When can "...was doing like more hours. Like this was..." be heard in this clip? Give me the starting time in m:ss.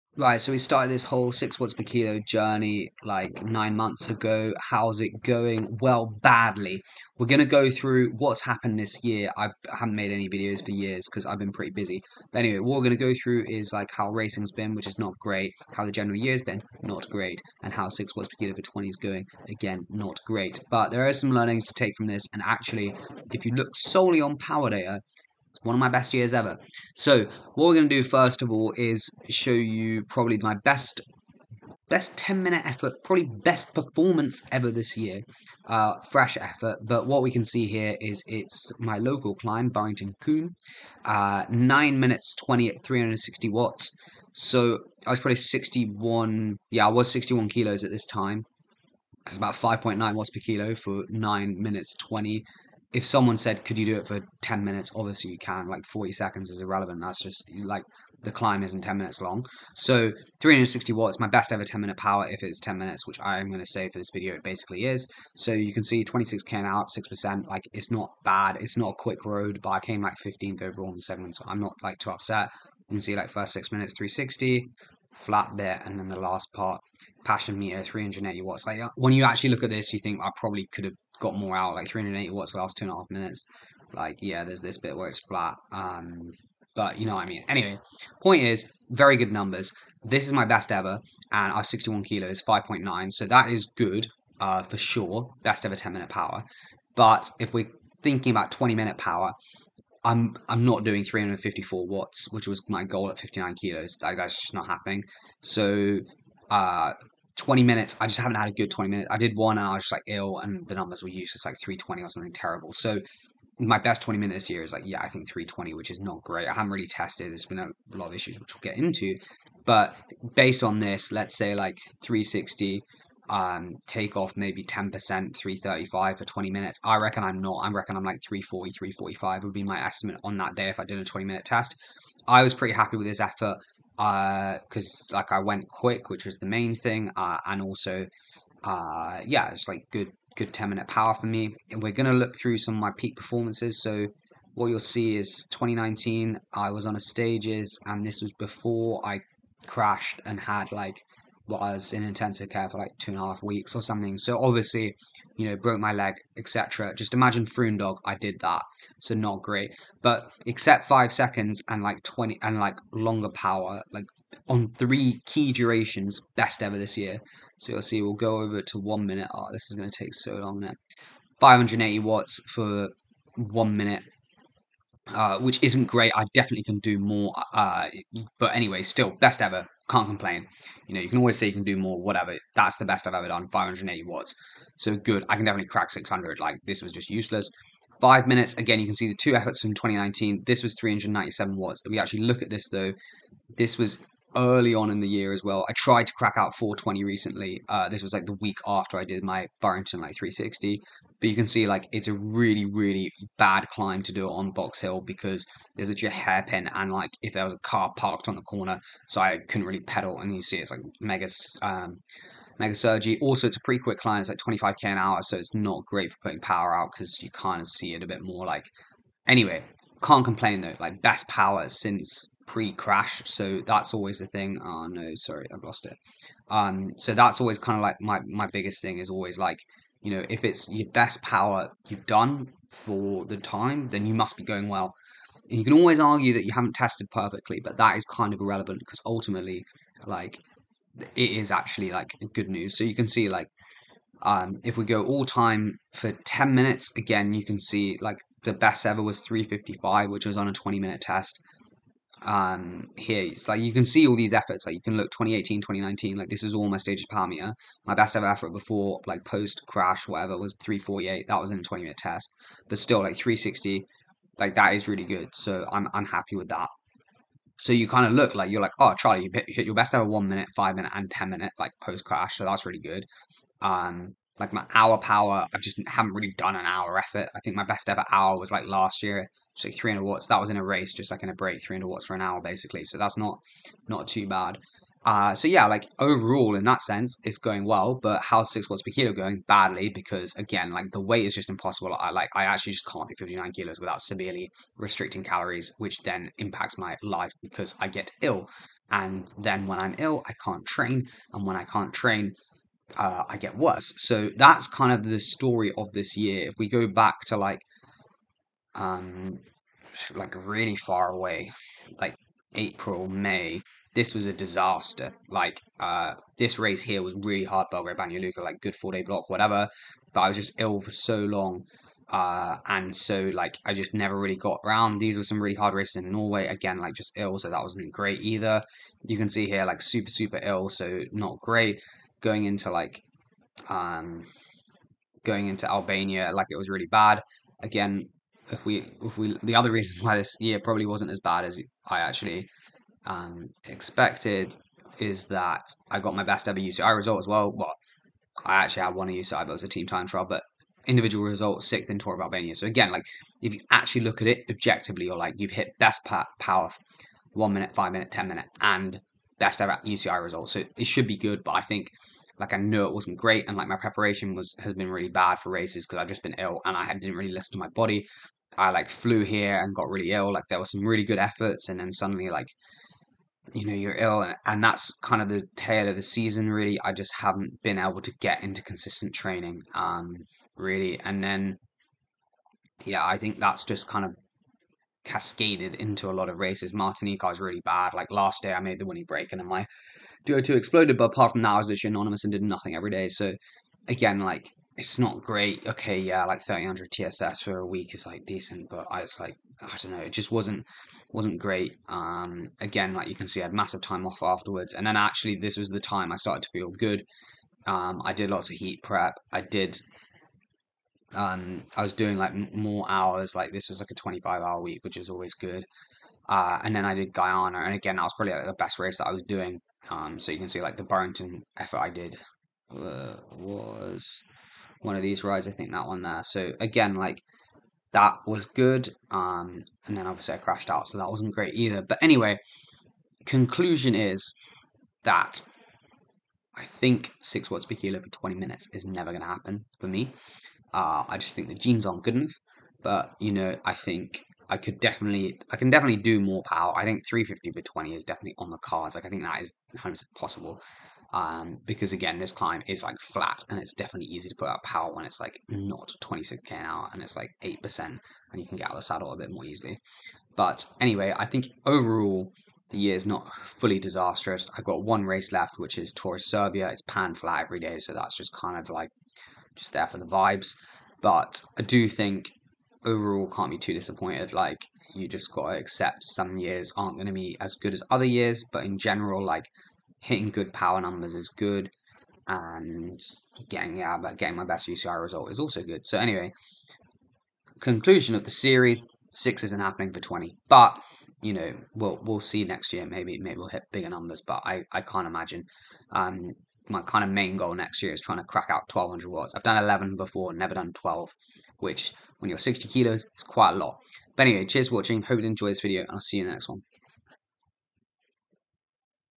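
6:51.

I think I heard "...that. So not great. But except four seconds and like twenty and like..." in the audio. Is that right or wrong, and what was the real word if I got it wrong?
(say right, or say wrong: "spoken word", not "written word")
wrong: "five", not "four".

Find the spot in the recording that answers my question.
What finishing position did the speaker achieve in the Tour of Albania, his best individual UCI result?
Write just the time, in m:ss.
5:51.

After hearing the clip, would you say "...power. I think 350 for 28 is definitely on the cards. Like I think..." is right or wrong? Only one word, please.
wrong.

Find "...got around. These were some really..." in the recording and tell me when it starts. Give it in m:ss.
5:24.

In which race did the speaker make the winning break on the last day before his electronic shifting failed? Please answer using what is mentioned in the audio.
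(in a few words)
Martinique.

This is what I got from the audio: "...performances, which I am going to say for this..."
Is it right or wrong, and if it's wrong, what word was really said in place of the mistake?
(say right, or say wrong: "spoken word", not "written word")
wrong: "minutes", not "performances".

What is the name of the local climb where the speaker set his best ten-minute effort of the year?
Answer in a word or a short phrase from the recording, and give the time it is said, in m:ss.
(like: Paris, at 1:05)
Burrington Combe, at 0:39.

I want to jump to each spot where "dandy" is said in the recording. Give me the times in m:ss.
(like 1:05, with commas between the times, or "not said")
not said.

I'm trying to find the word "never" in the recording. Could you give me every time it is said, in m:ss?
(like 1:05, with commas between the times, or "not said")
5:23, 7:18, 8:20.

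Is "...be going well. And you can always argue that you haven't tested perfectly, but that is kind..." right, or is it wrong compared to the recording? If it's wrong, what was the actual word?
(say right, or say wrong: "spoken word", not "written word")
right.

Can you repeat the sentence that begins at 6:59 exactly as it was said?
Um, so you can see like the Burrington effort I did uh, was one of these rides.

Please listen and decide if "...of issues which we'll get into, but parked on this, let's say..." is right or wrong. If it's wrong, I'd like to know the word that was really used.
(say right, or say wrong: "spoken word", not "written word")
wrong: "based", not "parked".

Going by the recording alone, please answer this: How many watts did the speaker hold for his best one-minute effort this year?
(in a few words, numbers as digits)
580 watts.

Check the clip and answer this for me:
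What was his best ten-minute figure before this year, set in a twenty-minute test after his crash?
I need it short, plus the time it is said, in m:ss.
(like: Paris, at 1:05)
348, at 4:20.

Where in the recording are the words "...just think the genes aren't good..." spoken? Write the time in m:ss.
7:21.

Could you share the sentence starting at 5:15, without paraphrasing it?
Like, uh, this race here was really hard, Belgrade, Banja like good four day block, whatever.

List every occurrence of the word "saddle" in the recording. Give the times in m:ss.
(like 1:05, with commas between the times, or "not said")
7:38.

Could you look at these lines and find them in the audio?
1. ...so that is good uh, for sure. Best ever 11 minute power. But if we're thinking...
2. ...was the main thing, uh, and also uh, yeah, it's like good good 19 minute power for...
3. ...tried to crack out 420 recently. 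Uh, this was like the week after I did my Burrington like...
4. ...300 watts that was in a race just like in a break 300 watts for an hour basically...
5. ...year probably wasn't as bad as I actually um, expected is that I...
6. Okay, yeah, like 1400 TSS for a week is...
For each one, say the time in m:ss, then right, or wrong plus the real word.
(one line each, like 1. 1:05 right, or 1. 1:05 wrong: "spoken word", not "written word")
1. 1:33 wrong: "10", not "11"
2. 2:16 wrong: "10", not "19"
3. 3:15 right
4. 4:39 right
5. 5:40 right
6. 6:35 wrong: "1300", not "1400".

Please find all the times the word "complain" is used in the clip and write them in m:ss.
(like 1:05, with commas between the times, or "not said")
3:00, 3:40.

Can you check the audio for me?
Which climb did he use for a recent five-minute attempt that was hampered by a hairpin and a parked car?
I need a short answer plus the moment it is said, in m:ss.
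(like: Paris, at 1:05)
Box Hill, at 3:24.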